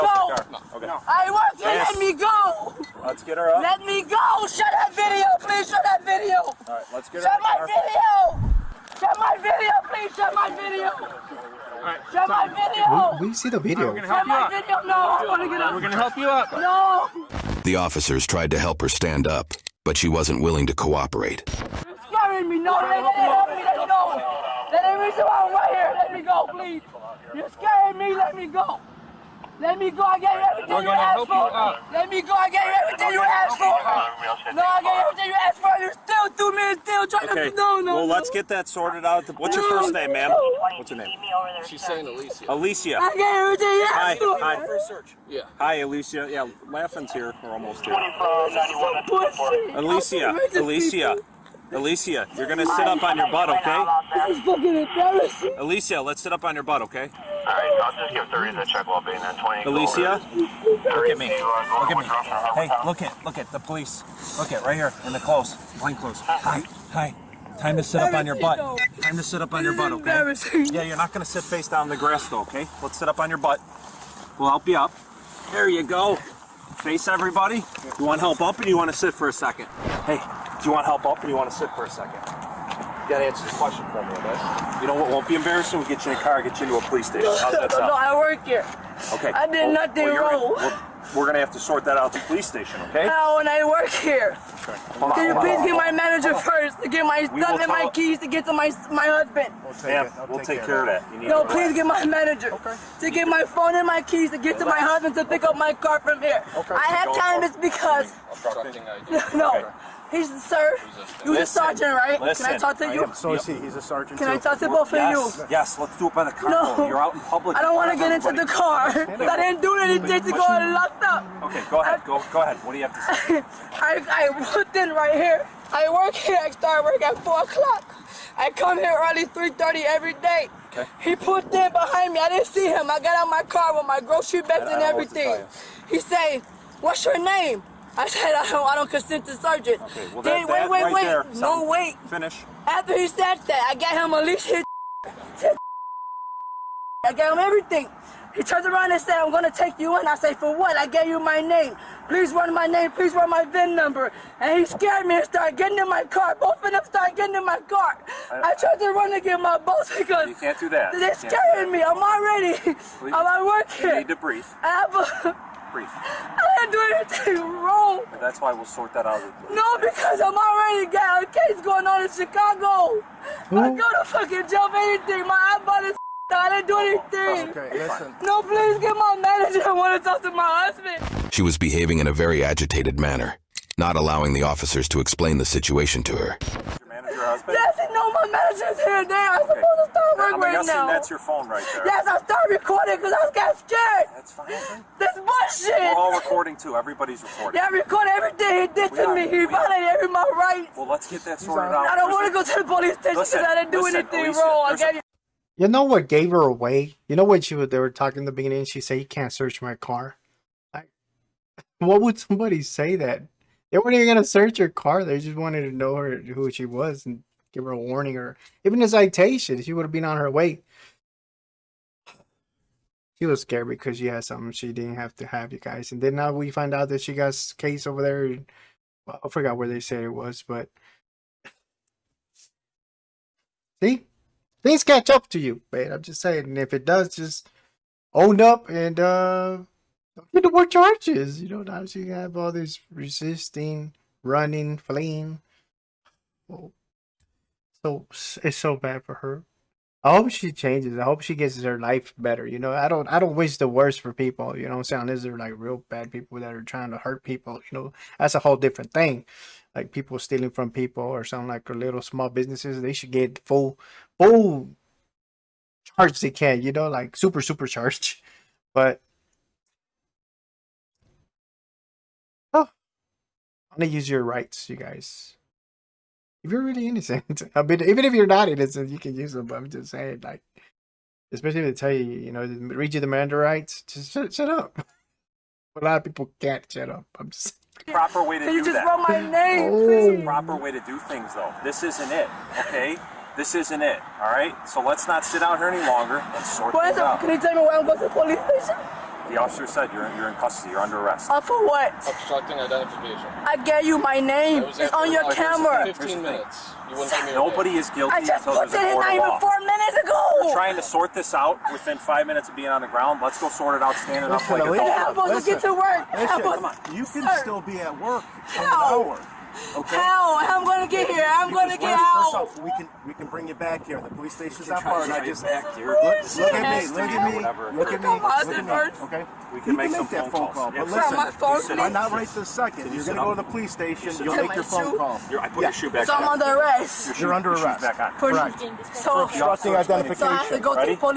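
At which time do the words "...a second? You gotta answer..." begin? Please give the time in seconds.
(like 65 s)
81 s.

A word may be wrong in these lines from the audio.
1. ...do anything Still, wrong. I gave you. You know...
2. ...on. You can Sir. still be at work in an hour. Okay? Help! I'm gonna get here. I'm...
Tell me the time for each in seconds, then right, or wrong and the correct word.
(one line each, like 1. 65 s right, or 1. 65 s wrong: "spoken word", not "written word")
1. 203 s wrong: "Alicia", not "Still"
2. 316 s right.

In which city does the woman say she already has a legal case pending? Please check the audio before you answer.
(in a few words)
Chicago.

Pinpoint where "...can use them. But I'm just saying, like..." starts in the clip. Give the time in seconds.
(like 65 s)
278 s.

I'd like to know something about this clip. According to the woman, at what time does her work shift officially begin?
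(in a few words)
4 o'clock.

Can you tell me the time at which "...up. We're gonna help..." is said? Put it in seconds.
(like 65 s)
15 s.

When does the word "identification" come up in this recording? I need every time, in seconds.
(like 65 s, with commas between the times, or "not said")
302 s, 339 s.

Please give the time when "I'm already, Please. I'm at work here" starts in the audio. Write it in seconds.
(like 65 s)
161 s.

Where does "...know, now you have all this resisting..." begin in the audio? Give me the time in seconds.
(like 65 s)
241 s.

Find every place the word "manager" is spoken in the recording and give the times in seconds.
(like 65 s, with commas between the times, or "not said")
95 s, 102 s, 179 s, 188 s.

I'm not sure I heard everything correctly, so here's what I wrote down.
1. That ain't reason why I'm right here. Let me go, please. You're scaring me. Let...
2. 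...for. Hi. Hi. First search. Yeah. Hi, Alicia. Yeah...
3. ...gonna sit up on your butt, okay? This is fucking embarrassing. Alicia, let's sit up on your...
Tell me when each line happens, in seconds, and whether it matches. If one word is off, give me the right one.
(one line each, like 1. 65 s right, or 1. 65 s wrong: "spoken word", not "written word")
1. 24 s right
2. 44 s right
3. 52 s right.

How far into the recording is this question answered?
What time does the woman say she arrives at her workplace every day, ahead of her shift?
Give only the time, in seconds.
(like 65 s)
129 s.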